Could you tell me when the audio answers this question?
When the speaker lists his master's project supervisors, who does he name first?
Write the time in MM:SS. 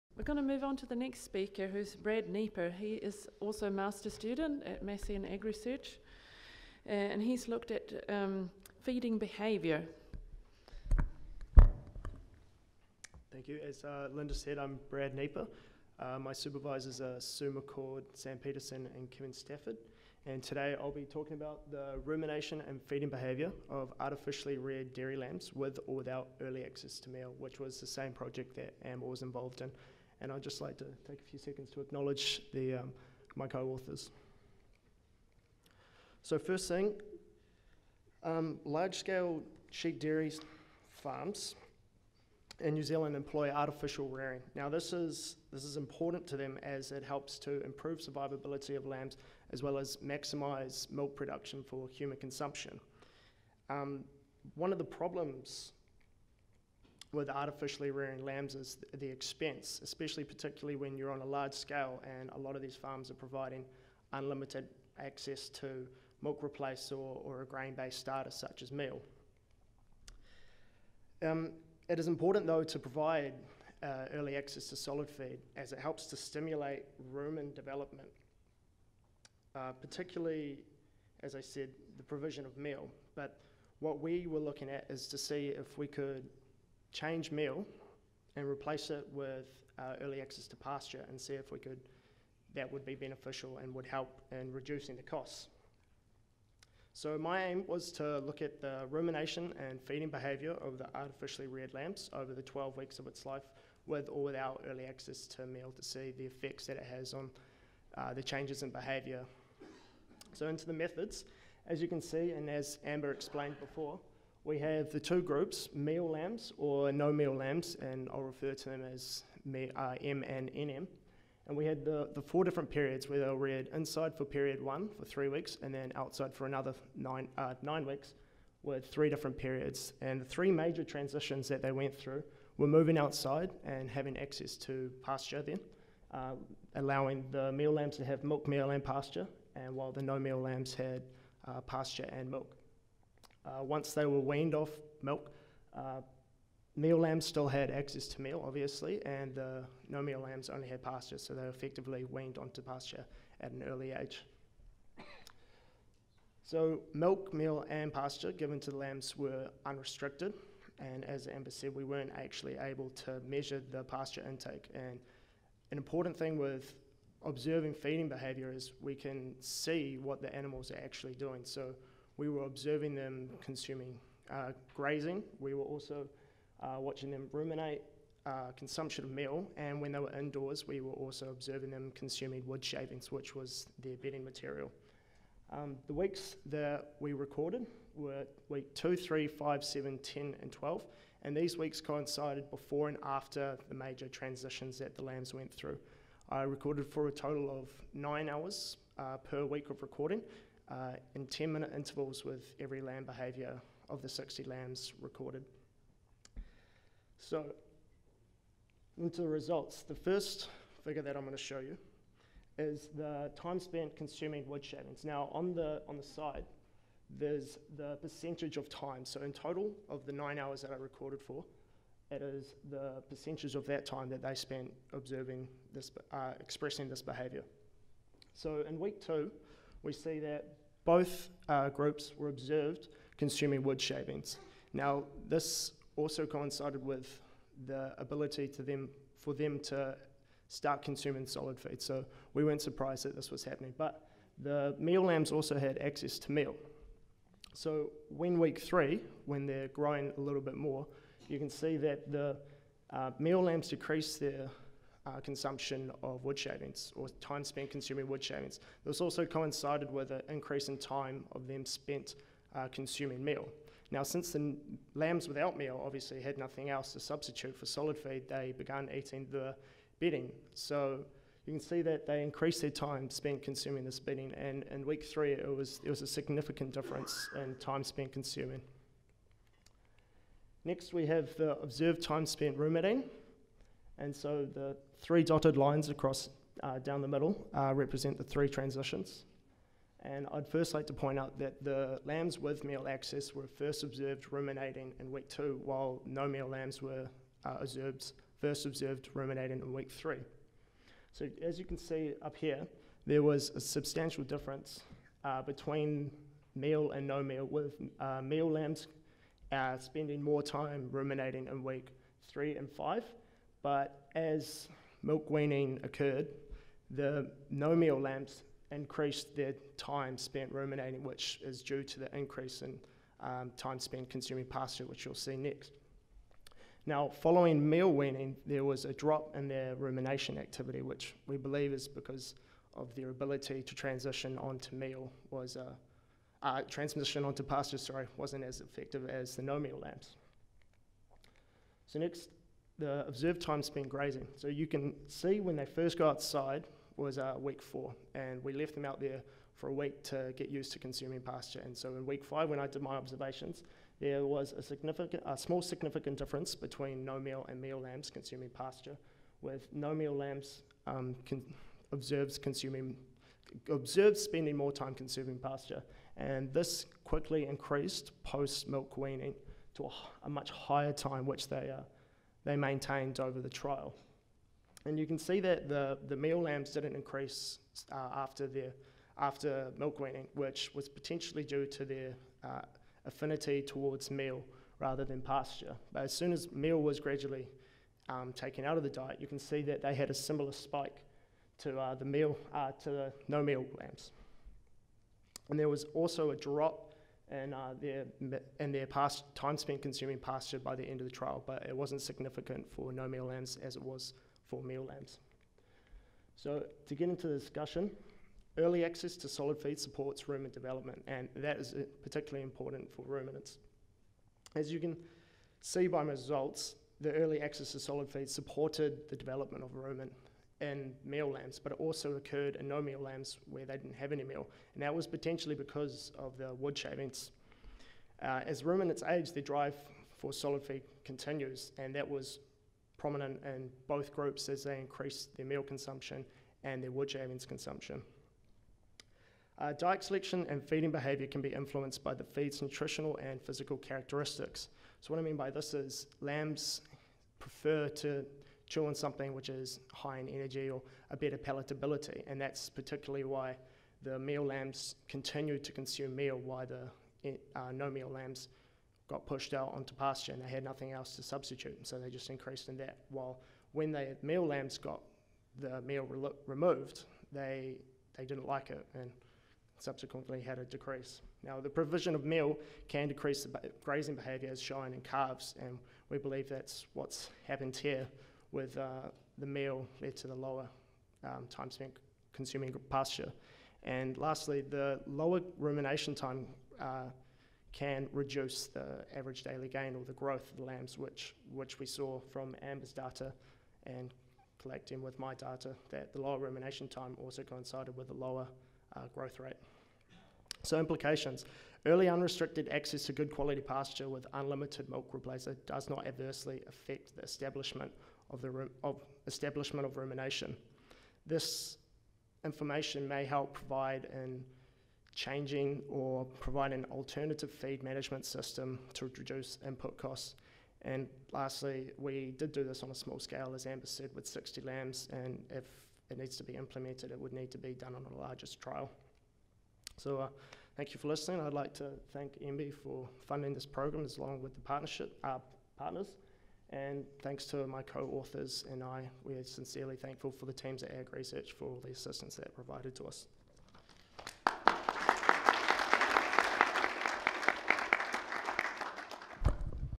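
00:17.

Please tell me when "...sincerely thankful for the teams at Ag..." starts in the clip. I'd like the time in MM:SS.
08:59.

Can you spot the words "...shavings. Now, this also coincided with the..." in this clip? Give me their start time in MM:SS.
03:53.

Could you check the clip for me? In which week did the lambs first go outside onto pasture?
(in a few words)
Week 4.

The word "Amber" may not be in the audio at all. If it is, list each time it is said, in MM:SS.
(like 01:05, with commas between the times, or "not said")
00:28, 01:52, 02:41, 08:12, 08:43.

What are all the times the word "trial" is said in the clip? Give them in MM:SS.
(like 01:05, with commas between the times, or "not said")
06:13, 06:41, 08:48.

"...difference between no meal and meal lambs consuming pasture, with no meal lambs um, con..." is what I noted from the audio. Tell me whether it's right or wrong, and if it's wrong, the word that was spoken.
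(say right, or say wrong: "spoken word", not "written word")
right.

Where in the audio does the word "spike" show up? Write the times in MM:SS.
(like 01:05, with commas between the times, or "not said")
06:30.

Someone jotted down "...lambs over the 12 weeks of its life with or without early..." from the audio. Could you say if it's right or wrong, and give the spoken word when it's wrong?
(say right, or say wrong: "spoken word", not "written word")
right.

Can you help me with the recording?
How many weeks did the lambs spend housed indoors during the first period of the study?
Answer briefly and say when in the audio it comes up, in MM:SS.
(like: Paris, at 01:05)
3, at 02:05.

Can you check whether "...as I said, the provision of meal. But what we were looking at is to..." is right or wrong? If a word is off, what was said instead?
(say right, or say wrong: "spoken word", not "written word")
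right.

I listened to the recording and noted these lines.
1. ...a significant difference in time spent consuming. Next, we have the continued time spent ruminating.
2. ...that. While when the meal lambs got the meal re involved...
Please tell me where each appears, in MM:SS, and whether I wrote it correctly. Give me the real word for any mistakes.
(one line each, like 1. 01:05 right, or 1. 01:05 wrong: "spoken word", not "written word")
1. 04:36 wrong: "observed", not "continued"
2. 07:42 wrong: "removed", not "involved".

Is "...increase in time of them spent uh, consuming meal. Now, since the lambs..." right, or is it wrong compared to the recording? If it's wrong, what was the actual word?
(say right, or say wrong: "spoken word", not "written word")
right.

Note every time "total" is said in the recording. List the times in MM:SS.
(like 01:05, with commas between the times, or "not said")
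03:17, 03:39.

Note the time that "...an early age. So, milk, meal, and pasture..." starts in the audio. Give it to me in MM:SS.
02:33.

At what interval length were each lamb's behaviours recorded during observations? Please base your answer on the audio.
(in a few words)
10 minutes.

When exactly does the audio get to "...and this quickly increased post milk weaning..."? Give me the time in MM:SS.
06:06.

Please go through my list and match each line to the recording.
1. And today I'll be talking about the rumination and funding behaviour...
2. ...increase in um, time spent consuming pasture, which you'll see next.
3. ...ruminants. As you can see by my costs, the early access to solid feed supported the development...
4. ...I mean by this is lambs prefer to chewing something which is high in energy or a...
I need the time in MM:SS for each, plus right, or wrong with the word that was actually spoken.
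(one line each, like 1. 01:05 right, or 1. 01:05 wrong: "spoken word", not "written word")
1. 00:20 wrong: "feeding", not "funding"
2. 05:22 right
3. 06:53 wrong: "results", not "costs"
4. 07:25 right.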